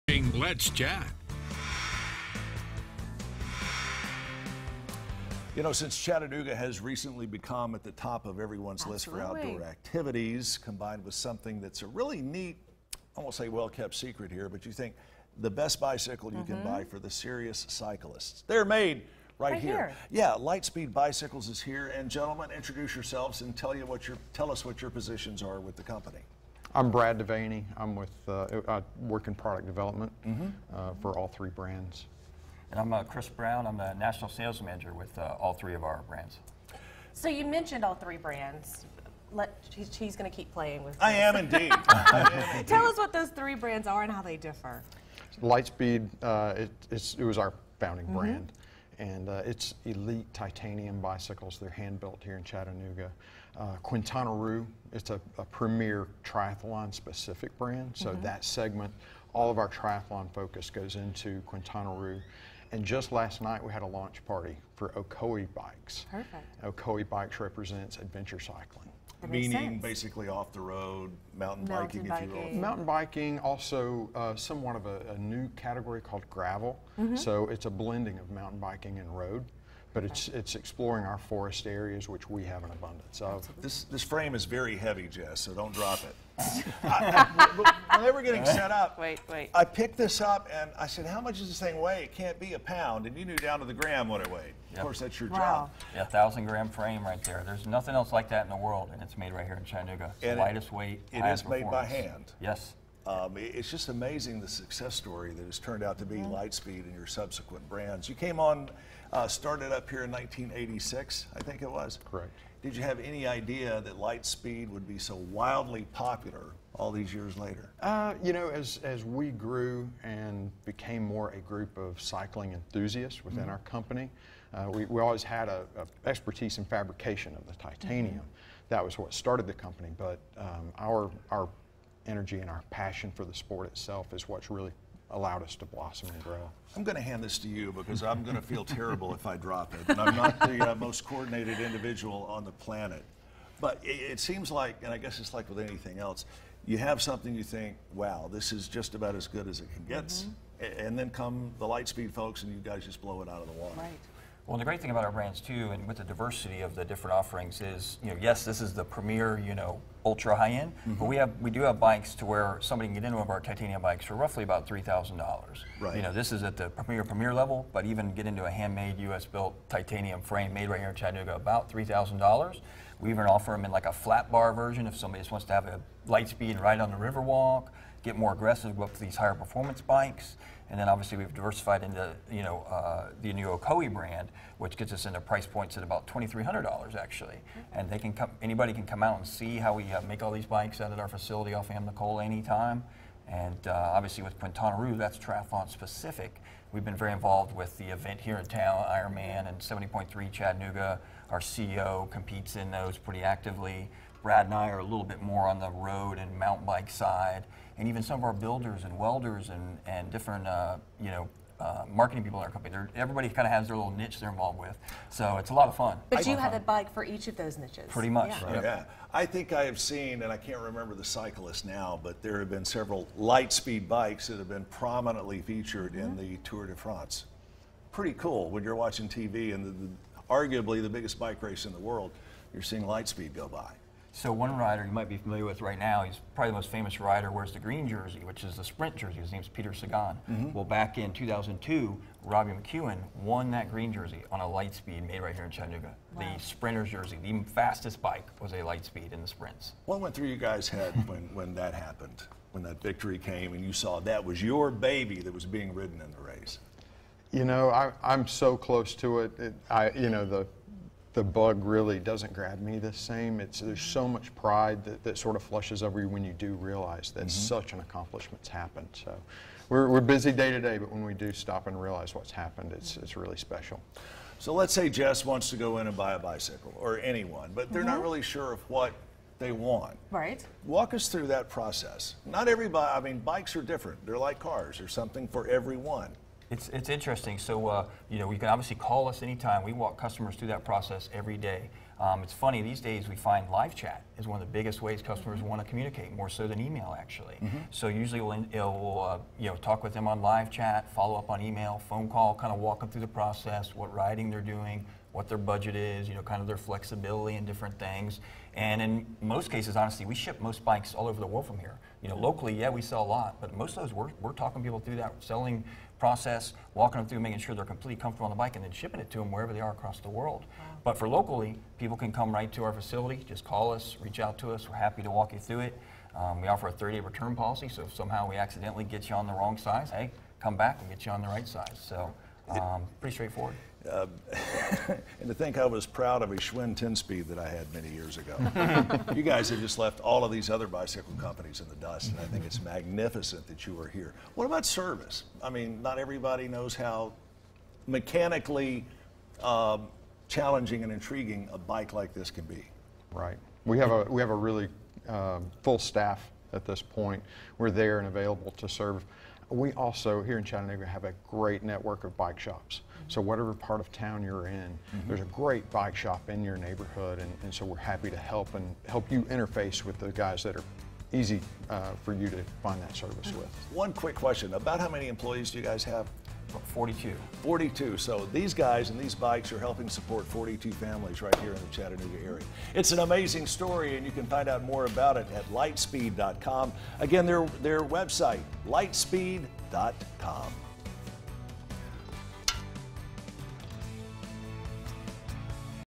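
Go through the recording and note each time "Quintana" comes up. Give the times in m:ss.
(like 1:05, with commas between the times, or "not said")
0:53, 1:01, 3:14.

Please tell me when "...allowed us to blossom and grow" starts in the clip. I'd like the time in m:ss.
2:15.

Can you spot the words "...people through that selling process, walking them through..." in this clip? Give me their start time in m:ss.
5:14.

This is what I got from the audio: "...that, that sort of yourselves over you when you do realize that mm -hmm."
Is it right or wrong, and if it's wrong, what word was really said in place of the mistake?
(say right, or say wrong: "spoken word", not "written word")
wrong: "flushes", not "yourselves".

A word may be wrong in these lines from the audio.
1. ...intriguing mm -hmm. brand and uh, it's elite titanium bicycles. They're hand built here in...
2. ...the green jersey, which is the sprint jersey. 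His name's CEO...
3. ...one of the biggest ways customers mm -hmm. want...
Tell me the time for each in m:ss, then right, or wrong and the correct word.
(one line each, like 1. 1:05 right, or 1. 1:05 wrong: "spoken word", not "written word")
1. 0:47 wrong: "founding", not "intriguing"
2. 3:57 wrong: "Peter", not "CEO"
3. 4:54 right.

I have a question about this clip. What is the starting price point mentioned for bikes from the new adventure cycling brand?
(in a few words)
$2,300.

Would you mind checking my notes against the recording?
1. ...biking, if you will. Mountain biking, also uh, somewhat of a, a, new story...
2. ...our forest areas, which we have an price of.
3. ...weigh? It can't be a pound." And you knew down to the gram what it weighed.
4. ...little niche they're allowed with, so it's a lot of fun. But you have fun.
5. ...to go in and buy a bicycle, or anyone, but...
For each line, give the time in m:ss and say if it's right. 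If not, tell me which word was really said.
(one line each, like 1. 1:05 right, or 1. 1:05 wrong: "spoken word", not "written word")
1. 1:12 wrong: "category", not "story"
2. 1:21 wrong: "abundance", not "price"
3. 1:31 right
4. 3:33 wrong: "involved", not "allowed"
5. 4:35 right.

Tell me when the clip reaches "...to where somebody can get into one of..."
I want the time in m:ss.
2:42.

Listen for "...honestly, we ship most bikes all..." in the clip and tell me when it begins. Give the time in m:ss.
5:09.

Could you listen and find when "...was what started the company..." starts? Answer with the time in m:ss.
2:08.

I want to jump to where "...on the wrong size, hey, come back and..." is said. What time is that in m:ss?
5:29.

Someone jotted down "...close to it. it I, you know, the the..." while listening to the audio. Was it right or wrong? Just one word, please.
right.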